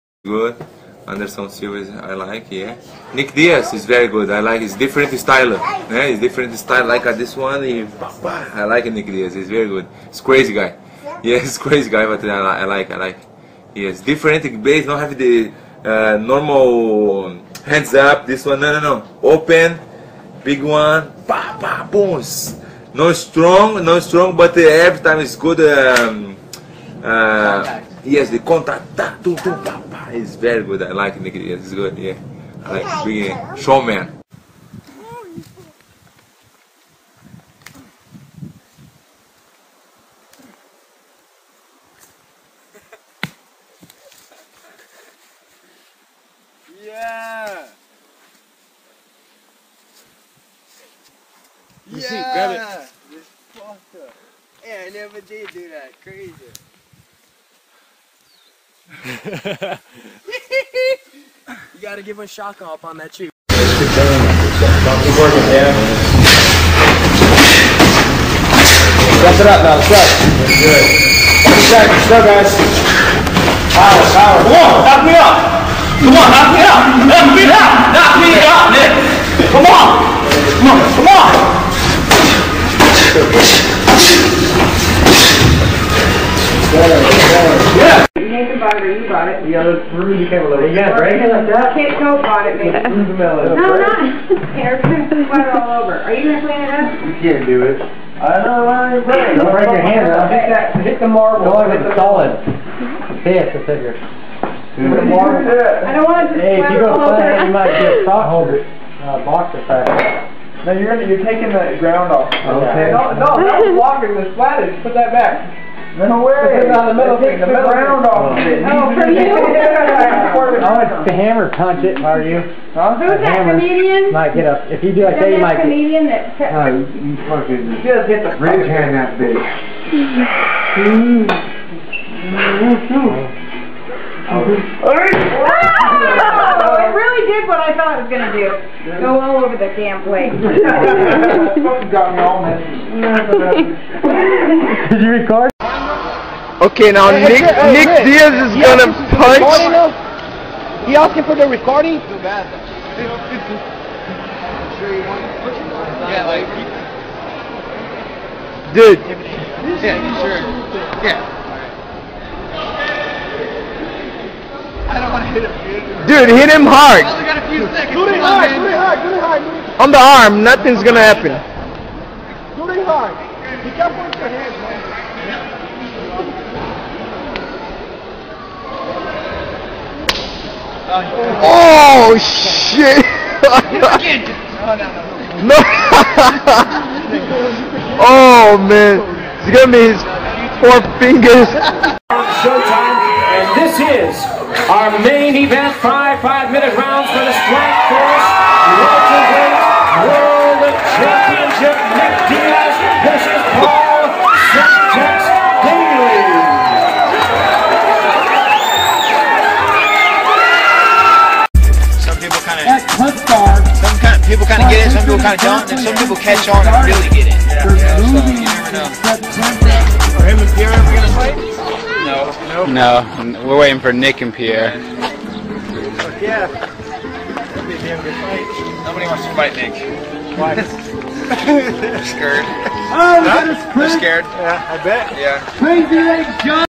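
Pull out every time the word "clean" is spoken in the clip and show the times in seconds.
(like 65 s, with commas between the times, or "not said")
96 s.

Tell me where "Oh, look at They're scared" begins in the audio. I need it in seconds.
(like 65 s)
232 s.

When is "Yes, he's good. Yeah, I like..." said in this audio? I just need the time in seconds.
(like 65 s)
31 s.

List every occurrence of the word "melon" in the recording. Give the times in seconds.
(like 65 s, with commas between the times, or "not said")
93 s.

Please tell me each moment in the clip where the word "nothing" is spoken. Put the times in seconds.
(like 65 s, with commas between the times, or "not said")
170 s.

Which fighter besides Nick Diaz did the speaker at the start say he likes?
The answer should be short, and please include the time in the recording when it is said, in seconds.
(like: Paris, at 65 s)
Anderson Silva, at 1 s.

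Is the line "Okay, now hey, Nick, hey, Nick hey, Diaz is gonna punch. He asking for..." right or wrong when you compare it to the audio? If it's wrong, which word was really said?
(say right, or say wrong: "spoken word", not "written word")
right.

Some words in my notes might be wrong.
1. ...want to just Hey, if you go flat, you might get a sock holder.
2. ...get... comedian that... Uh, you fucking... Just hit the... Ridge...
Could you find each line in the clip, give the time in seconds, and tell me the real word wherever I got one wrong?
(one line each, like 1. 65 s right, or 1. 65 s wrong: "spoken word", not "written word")
1. 105 s right
2. 125 s right.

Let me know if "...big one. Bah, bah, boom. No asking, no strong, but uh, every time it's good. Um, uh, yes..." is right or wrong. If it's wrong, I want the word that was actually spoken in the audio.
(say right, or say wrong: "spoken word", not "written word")
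wrong: "strong", not "asking".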